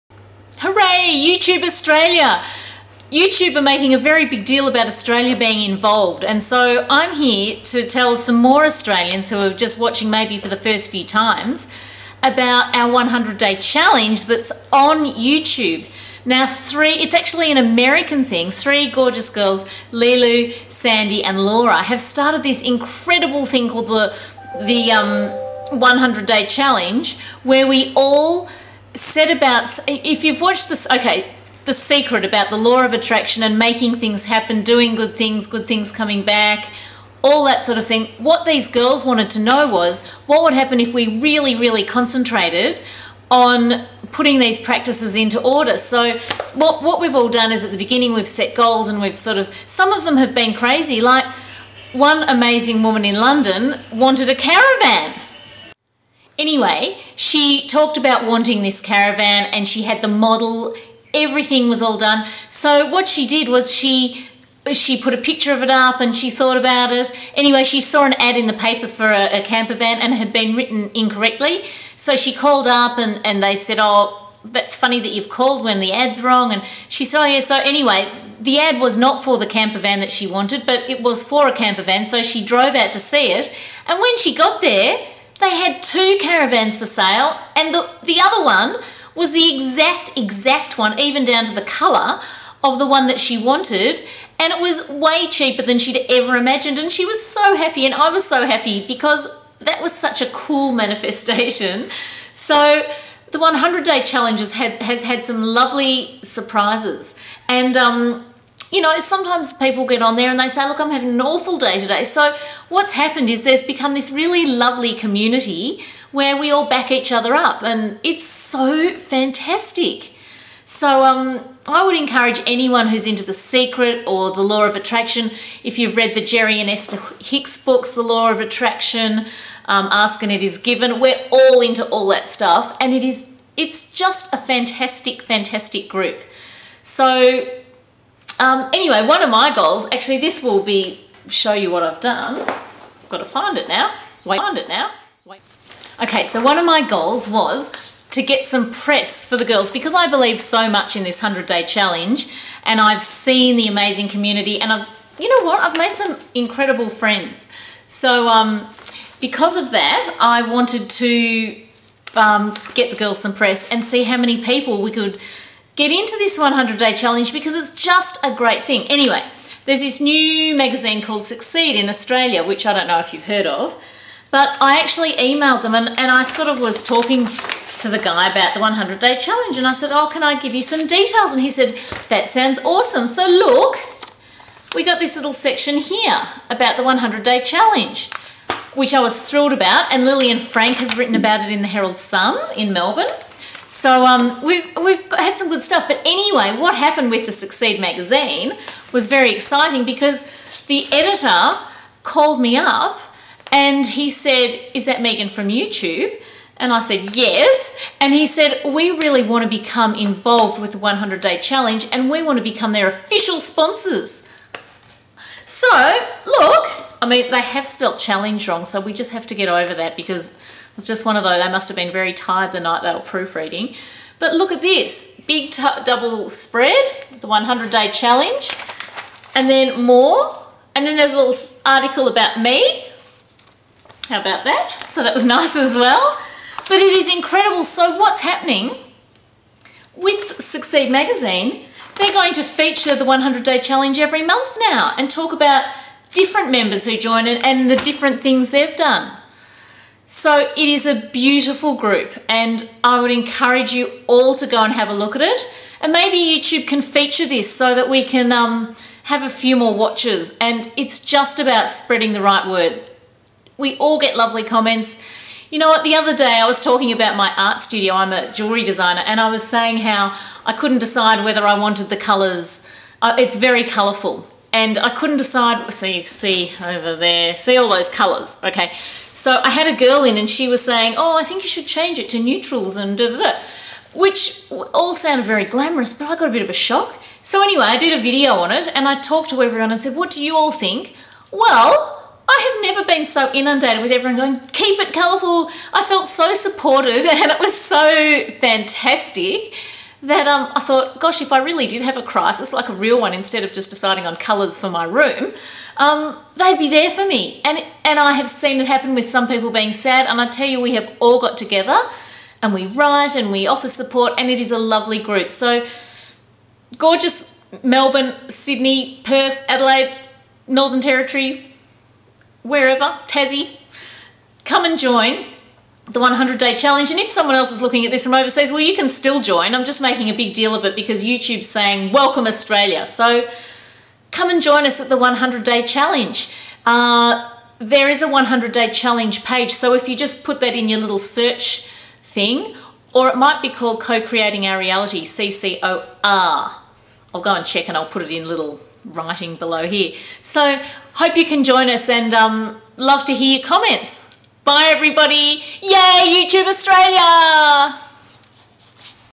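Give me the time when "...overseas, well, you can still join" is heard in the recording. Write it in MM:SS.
05:28.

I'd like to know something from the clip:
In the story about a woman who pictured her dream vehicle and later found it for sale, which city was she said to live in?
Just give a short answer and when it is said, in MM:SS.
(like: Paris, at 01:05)
London, at 00:53.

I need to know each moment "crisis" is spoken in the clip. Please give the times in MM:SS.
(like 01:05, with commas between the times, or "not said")
05:02.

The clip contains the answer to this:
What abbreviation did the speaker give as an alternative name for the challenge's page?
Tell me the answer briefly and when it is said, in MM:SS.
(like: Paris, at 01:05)
CCOR, at 05:45.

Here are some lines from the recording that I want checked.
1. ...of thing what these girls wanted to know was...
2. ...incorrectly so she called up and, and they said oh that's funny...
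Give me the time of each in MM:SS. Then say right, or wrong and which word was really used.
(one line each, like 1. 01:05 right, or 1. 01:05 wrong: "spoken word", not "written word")
1. 00:37 right
2. 01:10 right.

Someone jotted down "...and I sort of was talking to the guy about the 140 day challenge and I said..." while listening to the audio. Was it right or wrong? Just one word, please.
wrong.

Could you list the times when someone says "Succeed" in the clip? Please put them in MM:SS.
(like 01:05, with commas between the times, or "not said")
02:51, 03:17, 04:00.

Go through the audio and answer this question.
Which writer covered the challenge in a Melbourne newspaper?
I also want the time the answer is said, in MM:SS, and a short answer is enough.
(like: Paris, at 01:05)
Lillian Frank, at 03:10.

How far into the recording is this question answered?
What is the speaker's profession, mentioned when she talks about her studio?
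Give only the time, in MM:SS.
04:28.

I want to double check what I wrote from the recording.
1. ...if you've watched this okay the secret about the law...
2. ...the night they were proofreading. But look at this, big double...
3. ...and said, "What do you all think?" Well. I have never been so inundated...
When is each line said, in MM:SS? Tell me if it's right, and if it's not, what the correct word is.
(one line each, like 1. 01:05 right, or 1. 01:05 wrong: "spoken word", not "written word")
1. 00:29 right
2. 03:42 right
3. 04:49 right.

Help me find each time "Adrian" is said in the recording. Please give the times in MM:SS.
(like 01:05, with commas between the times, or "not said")
not said.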